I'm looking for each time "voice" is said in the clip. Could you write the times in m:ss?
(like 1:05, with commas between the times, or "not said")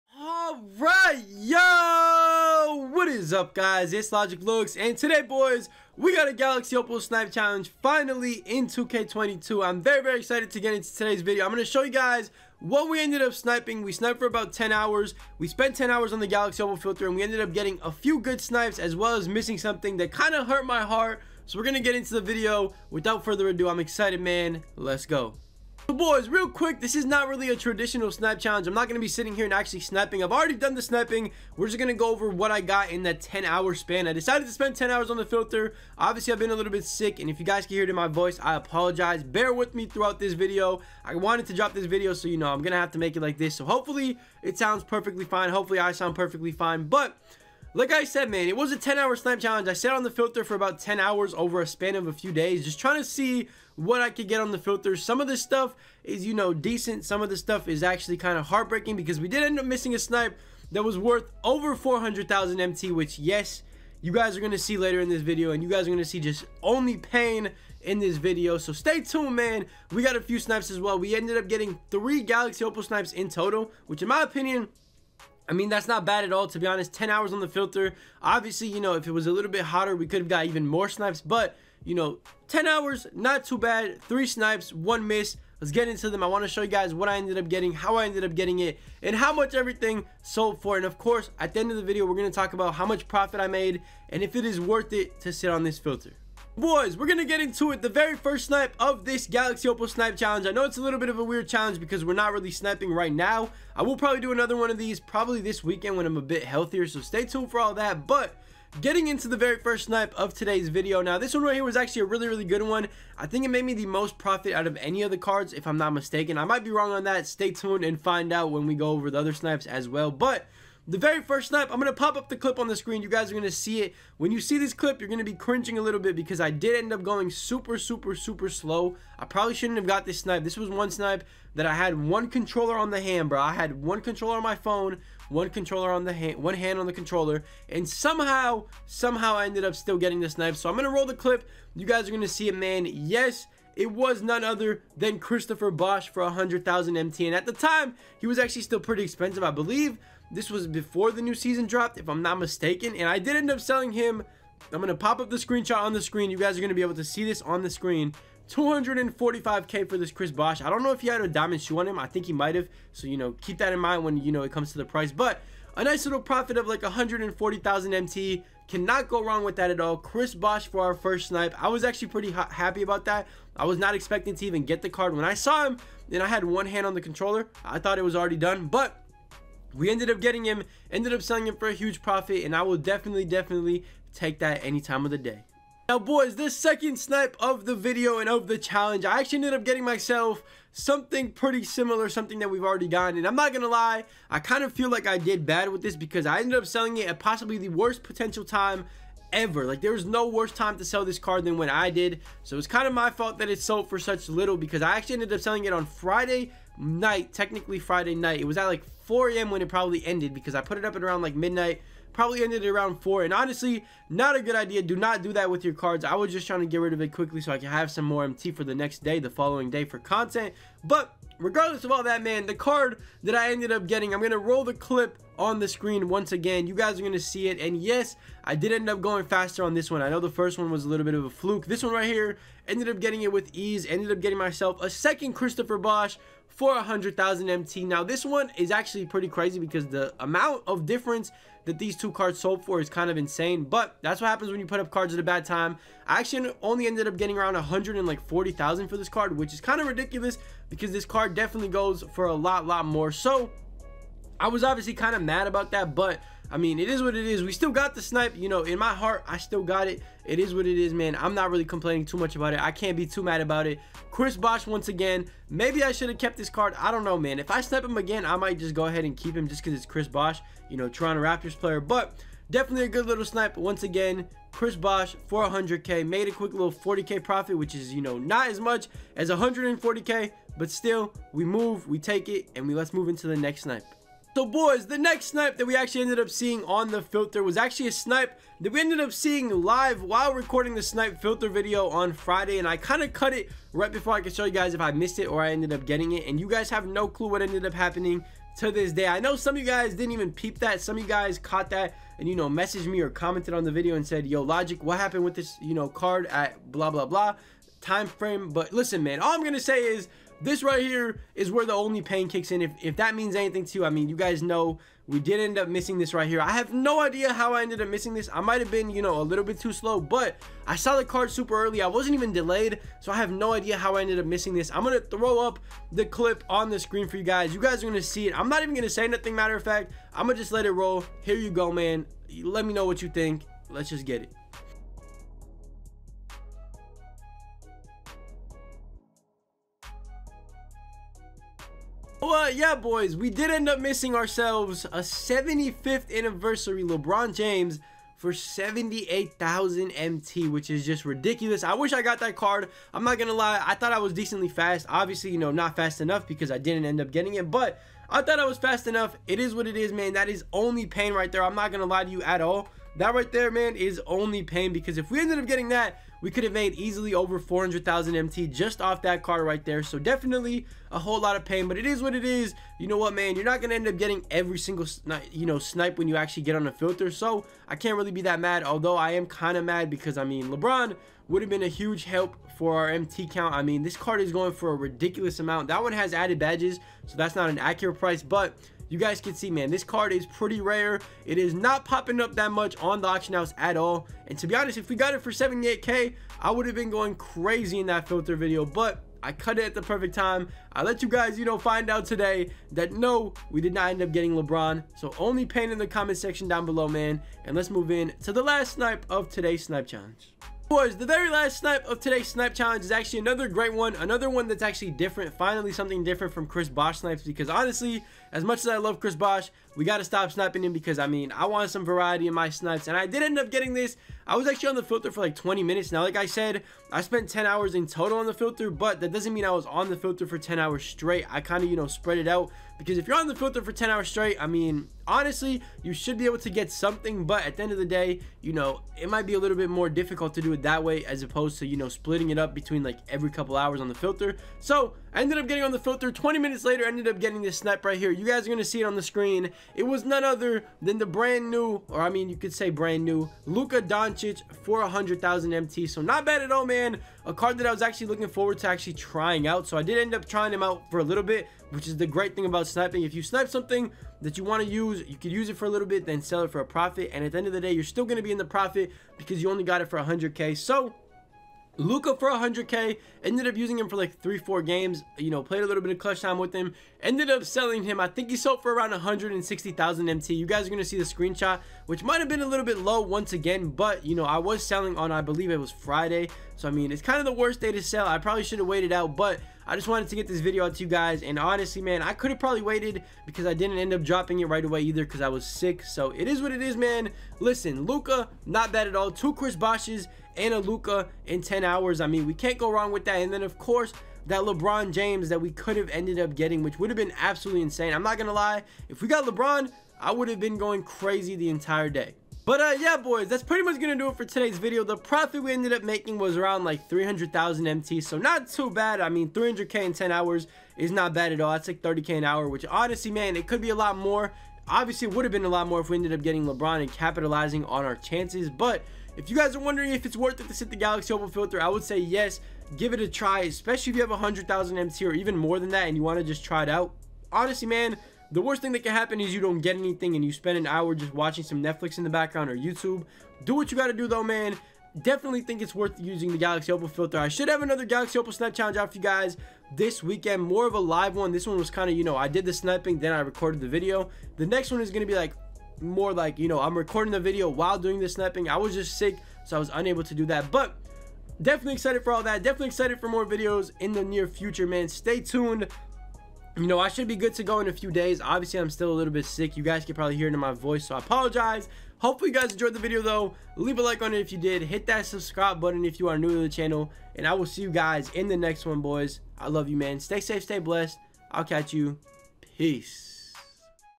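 0:38, 9:30.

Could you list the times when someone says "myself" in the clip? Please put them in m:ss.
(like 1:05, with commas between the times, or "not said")
3:09, 3:54.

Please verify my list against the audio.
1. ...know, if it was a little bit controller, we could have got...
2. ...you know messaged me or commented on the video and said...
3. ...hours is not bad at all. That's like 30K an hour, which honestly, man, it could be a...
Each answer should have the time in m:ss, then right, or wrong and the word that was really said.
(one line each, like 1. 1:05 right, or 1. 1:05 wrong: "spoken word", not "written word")
1. 1:18 wrong: "hotter", not "controller"
2. 5:02 right
3. 8:40 right.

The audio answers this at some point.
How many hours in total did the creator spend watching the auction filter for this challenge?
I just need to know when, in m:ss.
0:15.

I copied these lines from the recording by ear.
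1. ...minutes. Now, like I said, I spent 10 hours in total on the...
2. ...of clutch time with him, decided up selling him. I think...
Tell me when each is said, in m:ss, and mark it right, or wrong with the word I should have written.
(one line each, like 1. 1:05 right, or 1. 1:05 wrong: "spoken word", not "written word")
1. 7:05 right
2. 7:55 wrong: "ended", not "decided".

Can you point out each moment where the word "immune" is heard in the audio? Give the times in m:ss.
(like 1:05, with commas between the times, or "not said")
not said.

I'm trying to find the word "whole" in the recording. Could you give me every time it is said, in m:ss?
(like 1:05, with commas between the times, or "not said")
6:10.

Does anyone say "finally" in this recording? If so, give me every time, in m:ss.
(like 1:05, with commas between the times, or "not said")
0:07, 6:55.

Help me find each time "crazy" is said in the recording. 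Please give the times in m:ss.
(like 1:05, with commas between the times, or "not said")
3:59, 6:37, 8:30.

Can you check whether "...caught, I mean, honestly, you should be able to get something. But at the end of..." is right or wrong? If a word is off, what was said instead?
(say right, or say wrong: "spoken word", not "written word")
wrong: "straight", not "caught".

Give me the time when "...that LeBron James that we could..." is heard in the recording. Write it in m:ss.
8:24.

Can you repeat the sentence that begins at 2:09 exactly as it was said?
I probably shouldn't have got this snipe.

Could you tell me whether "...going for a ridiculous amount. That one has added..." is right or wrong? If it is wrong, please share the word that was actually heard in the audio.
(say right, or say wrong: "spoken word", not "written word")
right.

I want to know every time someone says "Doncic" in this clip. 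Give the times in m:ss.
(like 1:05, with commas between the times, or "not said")
7:33.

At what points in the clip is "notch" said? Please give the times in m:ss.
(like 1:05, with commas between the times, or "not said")
not said.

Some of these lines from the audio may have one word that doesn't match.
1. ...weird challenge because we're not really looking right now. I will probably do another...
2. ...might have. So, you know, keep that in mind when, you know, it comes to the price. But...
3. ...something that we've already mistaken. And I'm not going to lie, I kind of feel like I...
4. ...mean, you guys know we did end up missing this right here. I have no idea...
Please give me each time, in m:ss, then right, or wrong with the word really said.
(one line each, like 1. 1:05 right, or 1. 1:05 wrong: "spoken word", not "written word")
1. 1:41 wrong: "sniping", not "looking"
2. 2:42 right
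3. 3:12 wrong: "gotten", not "mistaken"
4. 5:13 right.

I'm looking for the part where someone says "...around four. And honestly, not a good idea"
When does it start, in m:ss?
3:32.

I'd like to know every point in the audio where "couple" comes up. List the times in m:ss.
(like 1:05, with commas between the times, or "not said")
7:23.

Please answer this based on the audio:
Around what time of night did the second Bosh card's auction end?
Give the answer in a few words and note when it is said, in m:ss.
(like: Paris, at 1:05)
4 a.m., at 3:29.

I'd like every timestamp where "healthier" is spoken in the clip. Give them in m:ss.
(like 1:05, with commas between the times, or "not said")
1:46.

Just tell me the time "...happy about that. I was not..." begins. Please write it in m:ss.
2:52.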